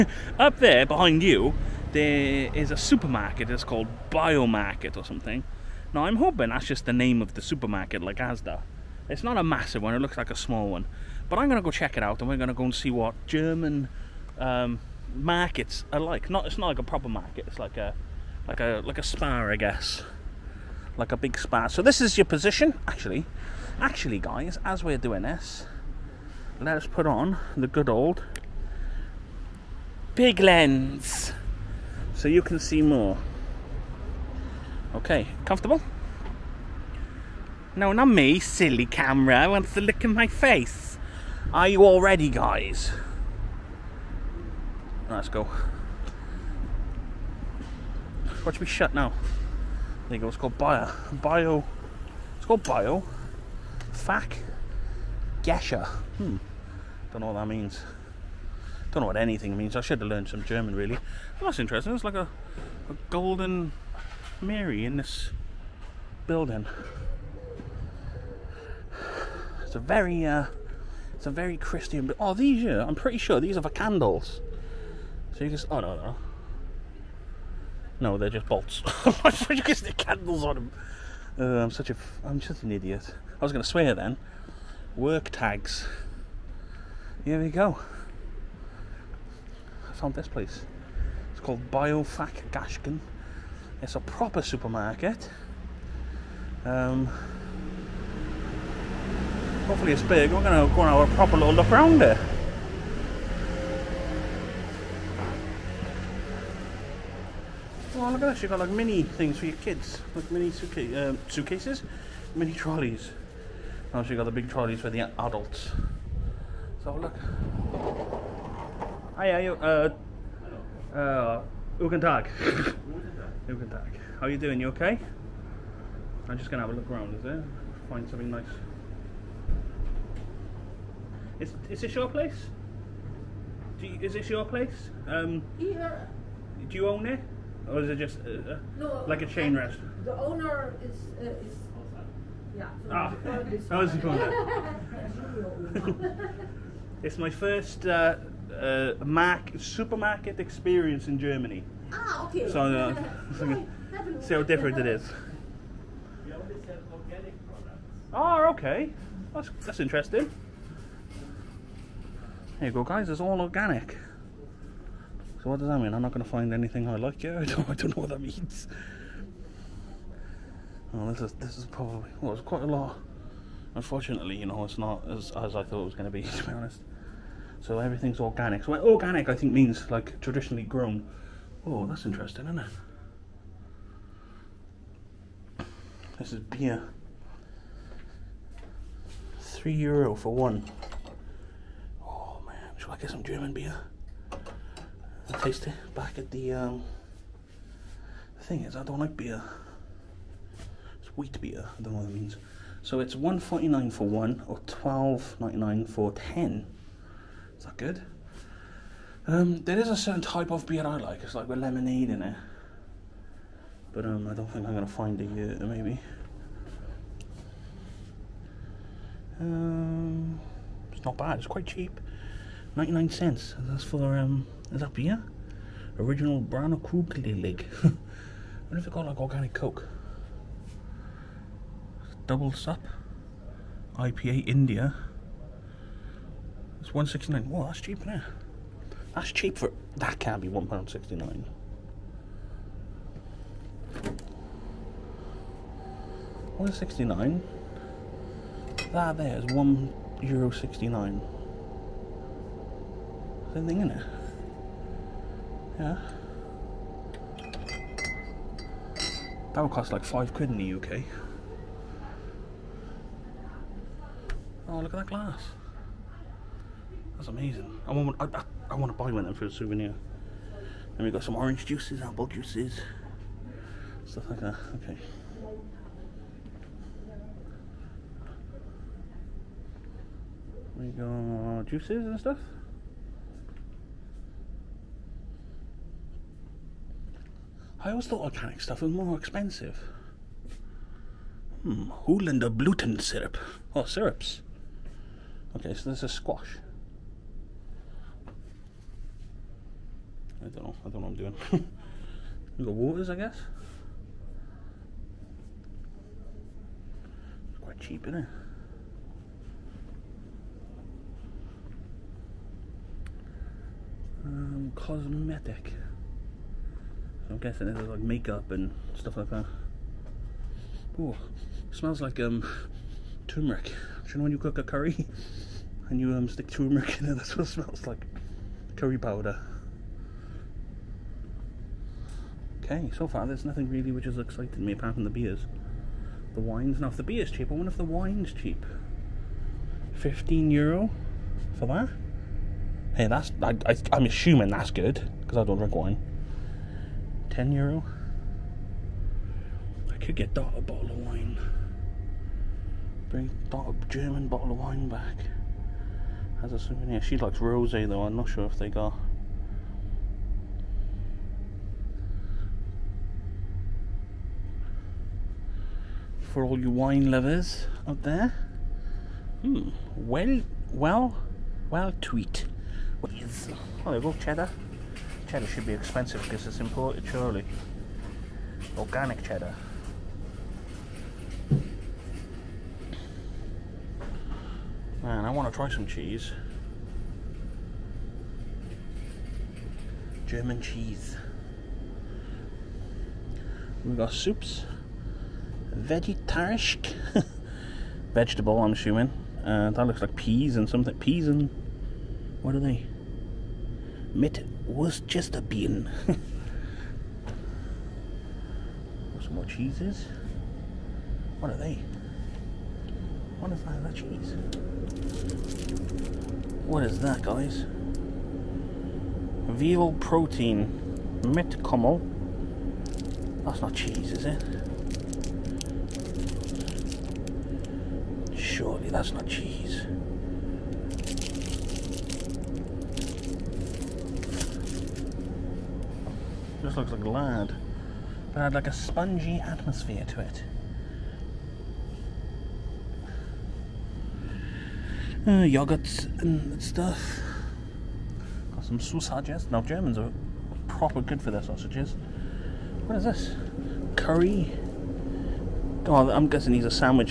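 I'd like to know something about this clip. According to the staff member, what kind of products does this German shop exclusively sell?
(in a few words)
Organic products.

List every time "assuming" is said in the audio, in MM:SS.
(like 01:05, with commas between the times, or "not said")
05:44, 06:38.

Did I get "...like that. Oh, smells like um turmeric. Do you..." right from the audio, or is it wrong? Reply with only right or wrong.
right.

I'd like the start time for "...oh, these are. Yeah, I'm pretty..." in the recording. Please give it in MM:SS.
01:12.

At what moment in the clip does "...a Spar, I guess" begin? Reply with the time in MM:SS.
00:18.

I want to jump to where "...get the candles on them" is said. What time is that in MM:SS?
01:19.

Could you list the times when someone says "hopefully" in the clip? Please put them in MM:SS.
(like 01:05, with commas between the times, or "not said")
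01:39.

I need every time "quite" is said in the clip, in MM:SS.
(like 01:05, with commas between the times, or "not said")
02:52, 03:41, 05:07.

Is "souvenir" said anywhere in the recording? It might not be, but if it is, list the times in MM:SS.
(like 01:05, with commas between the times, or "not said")
04:29, 05:56.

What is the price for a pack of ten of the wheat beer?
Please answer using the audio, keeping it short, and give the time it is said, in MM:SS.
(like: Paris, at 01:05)
12.99, at 03:24.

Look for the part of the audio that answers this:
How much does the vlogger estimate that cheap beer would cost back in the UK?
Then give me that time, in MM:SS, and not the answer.
04:20.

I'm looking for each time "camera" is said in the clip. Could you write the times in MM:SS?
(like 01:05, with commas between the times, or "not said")
00:38.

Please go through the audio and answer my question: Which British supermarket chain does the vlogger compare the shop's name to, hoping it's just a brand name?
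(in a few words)
Asda.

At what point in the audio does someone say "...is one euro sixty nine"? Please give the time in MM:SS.
04:09.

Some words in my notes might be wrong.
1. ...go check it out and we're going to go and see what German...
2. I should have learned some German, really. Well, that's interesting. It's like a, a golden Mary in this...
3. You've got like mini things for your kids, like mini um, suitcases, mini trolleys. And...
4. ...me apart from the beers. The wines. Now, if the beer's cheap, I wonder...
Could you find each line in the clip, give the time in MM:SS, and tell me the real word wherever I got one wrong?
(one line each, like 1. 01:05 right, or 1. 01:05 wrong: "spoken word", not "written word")
1. 00:11 right
2. 00:59 right
3. 01:48 right
4. 05:34 right.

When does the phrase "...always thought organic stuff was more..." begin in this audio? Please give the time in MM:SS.
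04:47.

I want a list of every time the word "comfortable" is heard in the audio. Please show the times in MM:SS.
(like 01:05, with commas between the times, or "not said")
00:35.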